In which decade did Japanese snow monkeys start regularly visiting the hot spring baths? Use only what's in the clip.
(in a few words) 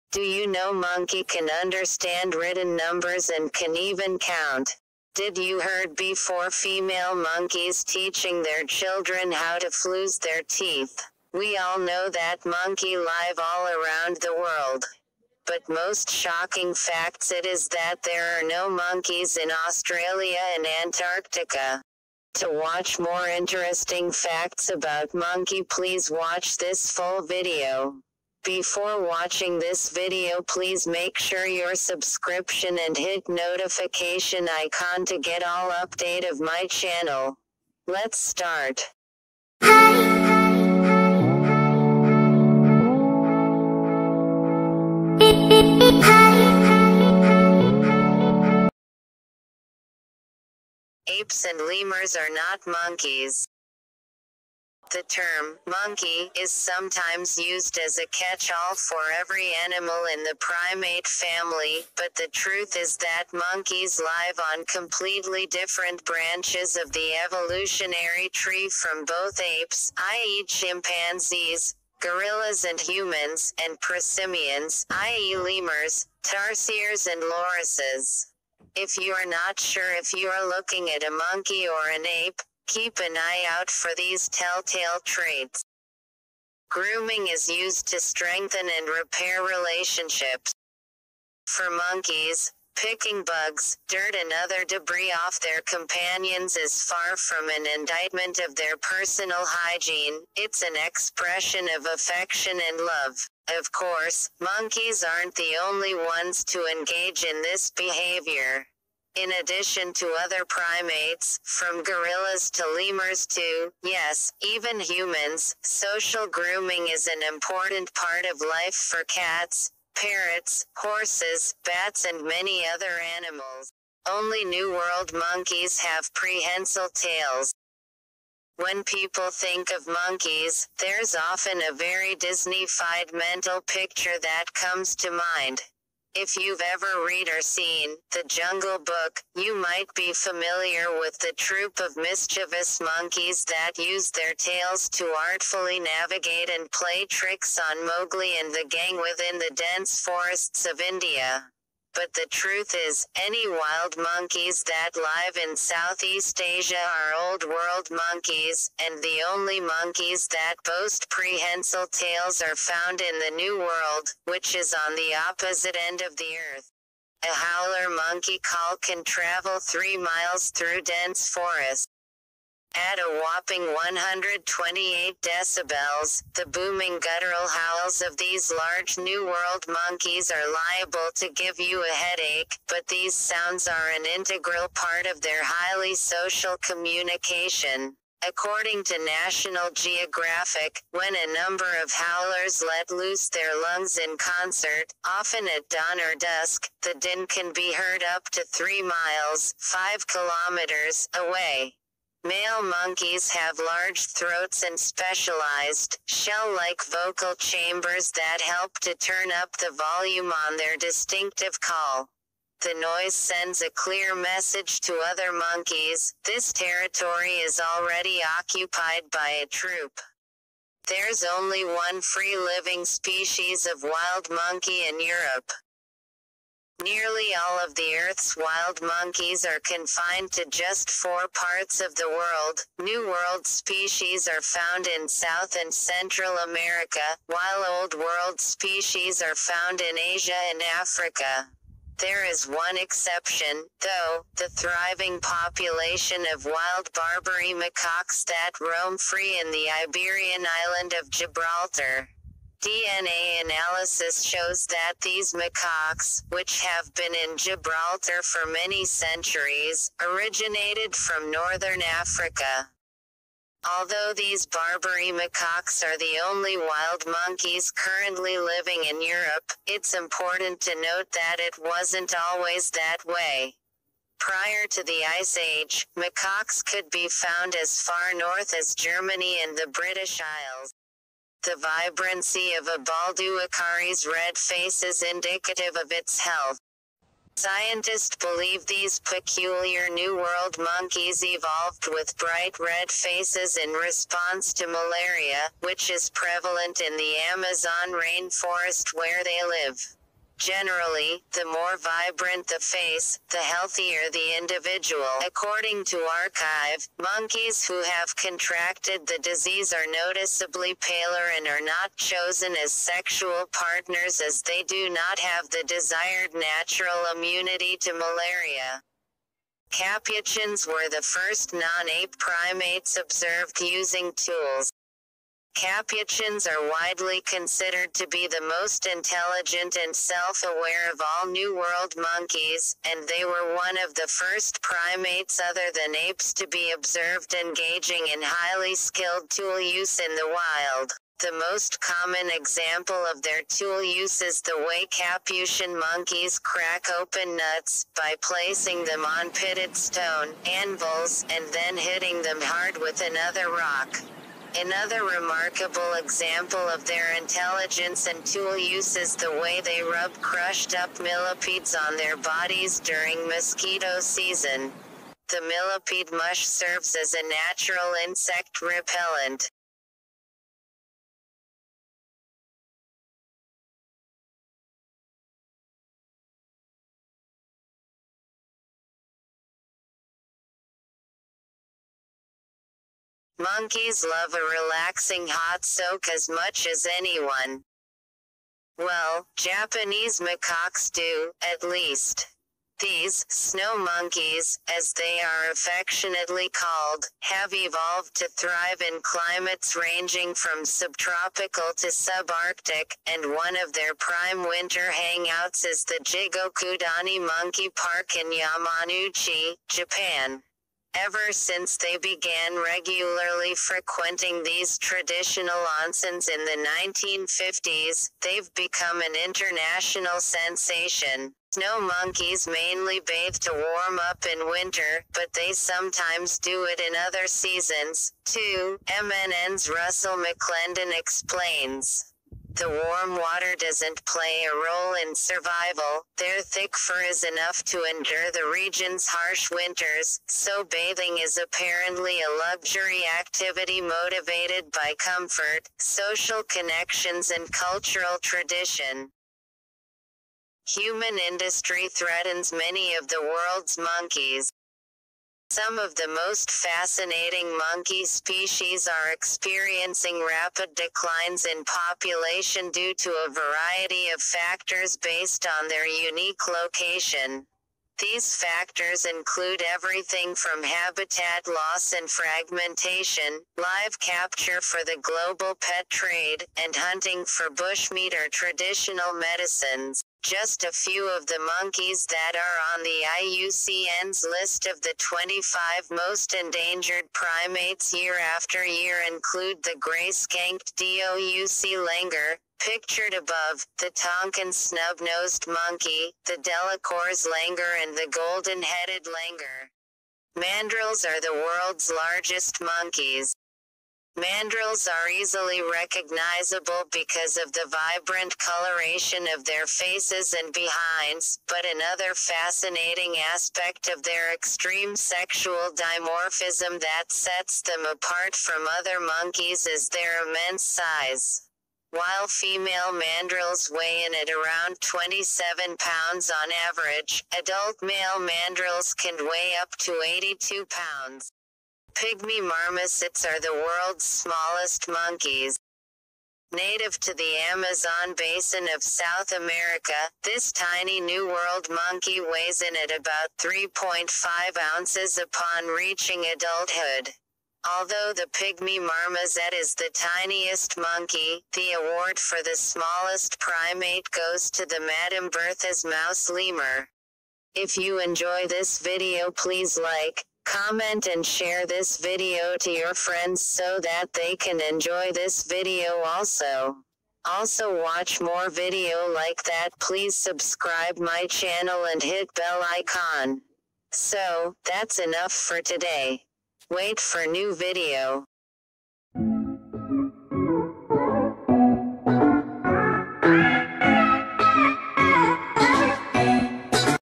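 1950s.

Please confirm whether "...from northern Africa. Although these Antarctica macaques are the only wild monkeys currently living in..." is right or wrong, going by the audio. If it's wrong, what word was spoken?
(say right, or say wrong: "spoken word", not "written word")
wrong: "Barbary", not "Antarctica".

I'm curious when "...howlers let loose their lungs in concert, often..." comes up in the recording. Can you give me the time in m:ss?
3:11.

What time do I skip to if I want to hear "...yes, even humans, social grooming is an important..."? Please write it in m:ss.
1:53.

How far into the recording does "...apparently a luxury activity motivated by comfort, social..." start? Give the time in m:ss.
7:21.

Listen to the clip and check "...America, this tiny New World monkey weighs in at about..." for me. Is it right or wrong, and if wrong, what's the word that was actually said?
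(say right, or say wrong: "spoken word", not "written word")
right.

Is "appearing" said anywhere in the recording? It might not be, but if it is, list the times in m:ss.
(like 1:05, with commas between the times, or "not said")
not said.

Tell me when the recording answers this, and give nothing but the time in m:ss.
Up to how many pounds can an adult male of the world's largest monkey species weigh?
8:50.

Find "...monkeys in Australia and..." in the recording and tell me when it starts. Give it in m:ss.
0:18.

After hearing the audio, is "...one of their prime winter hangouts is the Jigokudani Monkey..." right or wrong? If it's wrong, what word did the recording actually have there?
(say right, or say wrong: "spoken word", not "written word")
right.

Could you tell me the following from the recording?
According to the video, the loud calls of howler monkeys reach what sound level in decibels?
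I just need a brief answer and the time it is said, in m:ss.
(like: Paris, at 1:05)
128, at 2:53.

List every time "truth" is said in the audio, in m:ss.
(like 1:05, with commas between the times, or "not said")
1:02, 2:32.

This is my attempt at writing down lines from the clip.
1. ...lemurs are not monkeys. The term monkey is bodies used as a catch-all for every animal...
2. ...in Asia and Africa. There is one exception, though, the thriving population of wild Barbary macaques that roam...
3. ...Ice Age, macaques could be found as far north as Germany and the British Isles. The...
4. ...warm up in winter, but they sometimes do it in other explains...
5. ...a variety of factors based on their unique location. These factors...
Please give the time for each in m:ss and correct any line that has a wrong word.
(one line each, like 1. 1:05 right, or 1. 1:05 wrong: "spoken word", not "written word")
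1. 0:51 wrong: "sometimes", not "bodies"
2. 3:59 right
3. 4:35 right
4. 7:03 wrong: "seasons", not "explains"
5. 7:43 right.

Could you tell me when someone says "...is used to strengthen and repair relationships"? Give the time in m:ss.
1:27.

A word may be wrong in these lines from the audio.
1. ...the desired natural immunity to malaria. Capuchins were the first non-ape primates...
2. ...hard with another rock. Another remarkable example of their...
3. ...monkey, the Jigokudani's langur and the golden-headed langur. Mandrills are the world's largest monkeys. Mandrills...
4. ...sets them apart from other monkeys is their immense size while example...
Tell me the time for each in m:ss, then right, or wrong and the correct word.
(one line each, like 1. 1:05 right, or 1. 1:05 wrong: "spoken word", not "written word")
1. 5:15 right
2. 5:52 right
3. 8:15 wrong: "Delacour", not "Jigokudani"
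4. 8:37 wrong: "female", not "example".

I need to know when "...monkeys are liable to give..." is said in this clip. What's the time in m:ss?
2:59.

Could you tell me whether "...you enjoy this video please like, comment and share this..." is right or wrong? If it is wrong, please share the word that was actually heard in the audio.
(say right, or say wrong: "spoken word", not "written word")
right.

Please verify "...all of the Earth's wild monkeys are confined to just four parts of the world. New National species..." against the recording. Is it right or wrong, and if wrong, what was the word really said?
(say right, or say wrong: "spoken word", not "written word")
wrong: "World", not "National".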